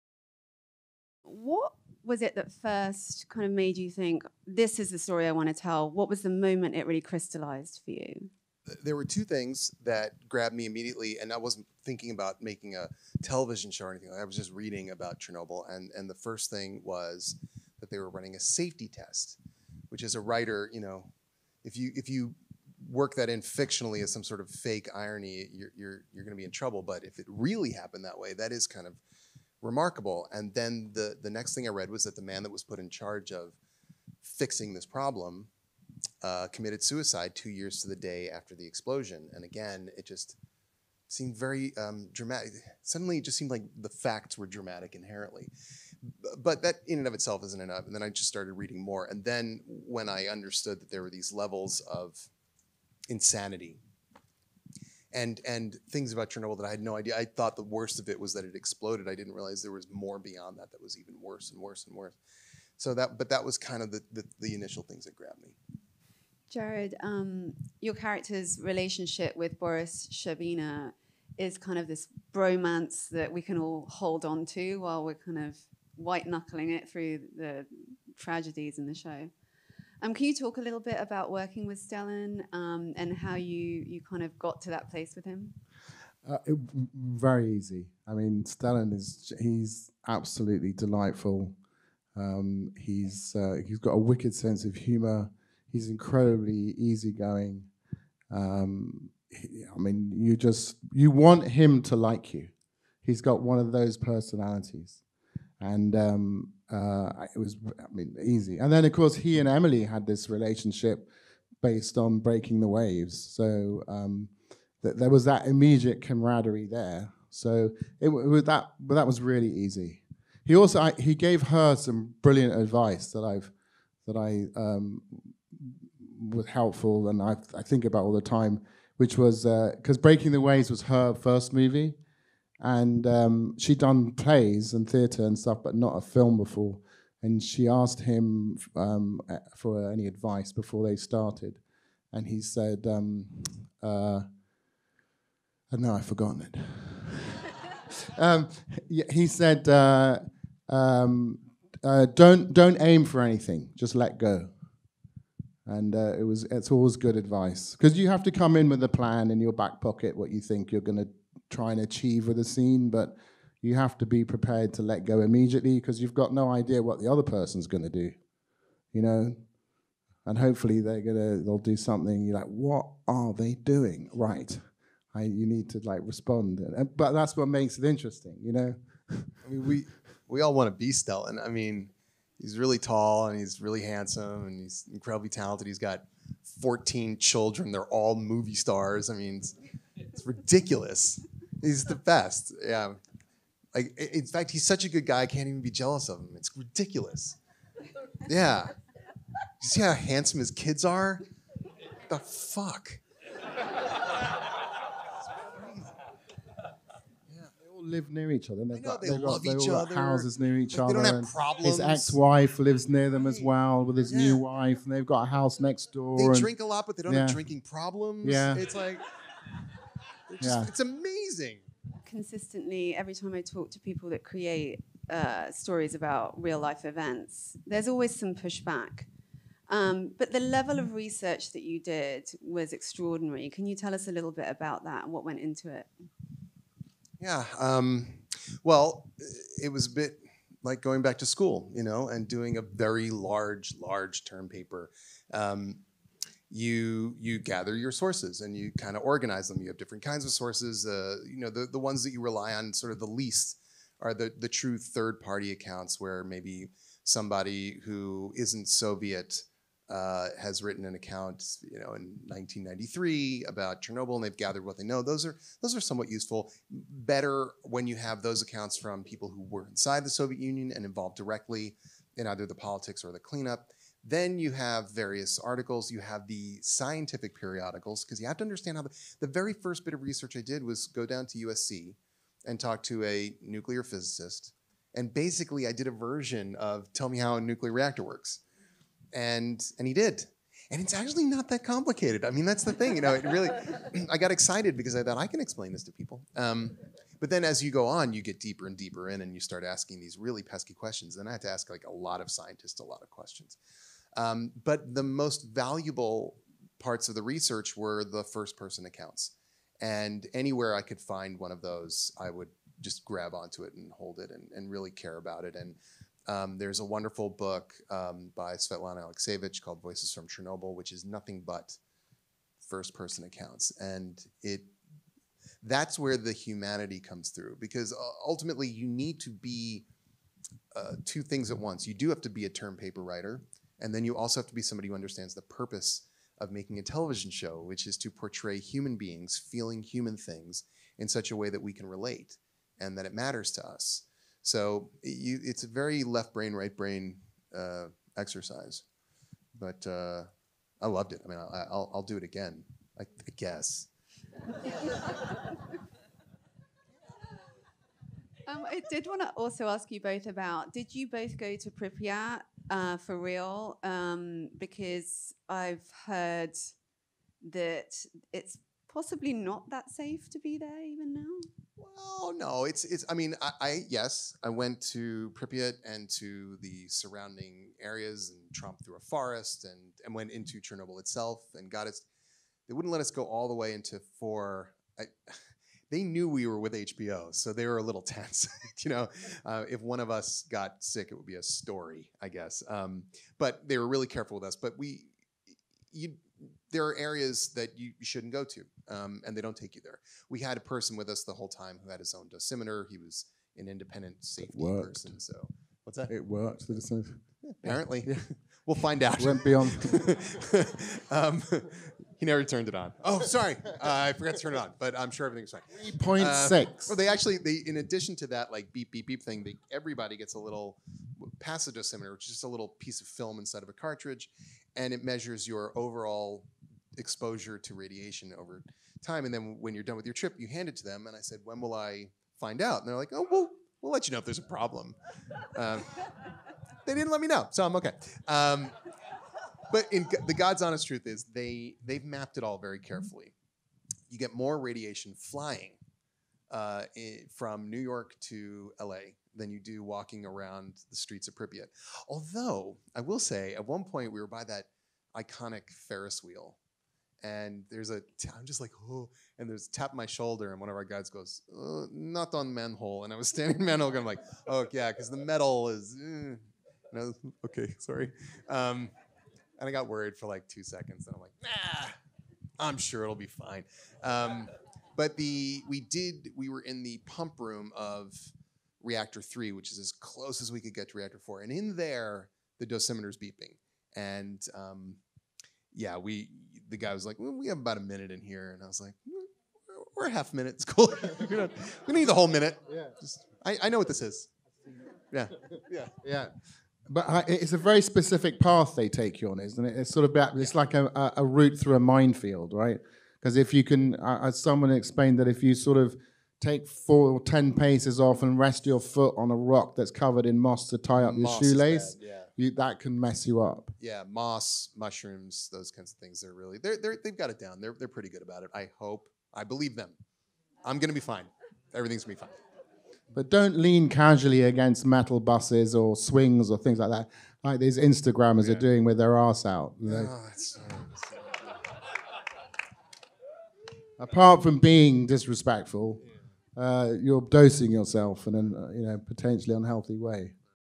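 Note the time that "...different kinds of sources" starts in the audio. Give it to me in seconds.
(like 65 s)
249 s.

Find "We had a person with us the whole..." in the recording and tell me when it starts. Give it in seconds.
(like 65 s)
400 s.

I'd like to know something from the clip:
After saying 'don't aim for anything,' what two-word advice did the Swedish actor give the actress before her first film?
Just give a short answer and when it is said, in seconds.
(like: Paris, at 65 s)
Just let go, at 153 s.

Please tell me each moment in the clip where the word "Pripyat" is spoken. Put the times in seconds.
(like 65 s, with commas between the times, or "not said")
361 s, 375 s, 451 s.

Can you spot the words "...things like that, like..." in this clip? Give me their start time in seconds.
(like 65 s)
526 s.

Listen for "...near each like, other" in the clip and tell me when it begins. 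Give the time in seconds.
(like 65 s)
210 s.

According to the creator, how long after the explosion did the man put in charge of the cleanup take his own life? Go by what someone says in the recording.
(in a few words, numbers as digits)
2 years.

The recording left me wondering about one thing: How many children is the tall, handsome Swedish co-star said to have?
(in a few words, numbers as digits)
14.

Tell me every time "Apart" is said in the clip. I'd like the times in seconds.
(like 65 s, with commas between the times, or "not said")
533 s.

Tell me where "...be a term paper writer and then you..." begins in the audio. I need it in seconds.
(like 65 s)
332 s.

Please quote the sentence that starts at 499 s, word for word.
It's sort of about, it's like a, a route through a minefield, right?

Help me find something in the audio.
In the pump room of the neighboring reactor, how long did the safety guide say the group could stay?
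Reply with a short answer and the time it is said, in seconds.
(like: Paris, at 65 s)
About a minute, at 487 s.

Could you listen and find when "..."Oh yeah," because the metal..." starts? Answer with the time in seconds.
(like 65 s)
464 s.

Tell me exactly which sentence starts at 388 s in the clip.
you know, uh, if one of us got sick, it would be a story, I guess.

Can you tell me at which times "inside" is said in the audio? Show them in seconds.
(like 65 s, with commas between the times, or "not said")
269 s, 423 s.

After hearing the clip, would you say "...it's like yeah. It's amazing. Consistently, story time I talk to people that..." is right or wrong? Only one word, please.
wrong.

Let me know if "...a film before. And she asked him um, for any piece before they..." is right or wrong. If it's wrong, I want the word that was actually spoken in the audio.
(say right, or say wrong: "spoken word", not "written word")
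wrong: "advice", not "piece".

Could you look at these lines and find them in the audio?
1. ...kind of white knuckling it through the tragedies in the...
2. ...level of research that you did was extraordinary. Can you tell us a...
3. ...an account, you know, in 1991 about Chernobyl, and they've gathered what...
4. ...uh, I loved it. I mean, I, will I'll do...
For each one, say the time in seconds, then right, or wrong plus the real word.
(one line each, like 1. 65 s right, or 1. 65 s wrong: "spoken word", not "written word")
1. 75 s right
2. 230 s right
3. 260 s wrong: "1993", not "1991"
4. 349 s right.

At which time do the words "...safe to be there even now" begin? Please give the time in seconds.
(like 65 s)
369 s.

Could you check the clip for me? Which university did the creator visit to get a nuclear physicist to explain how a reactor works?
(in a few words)
USC.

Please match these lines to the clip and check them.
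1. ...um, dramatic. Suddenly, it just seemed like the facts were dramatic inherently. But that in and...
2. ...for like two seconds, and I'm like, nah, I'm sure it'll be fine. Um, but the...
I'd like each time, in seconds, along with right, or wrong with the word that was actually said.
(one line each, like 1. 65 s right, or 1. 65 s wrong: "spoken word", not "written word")
1. 41 s right
2. 470 s right.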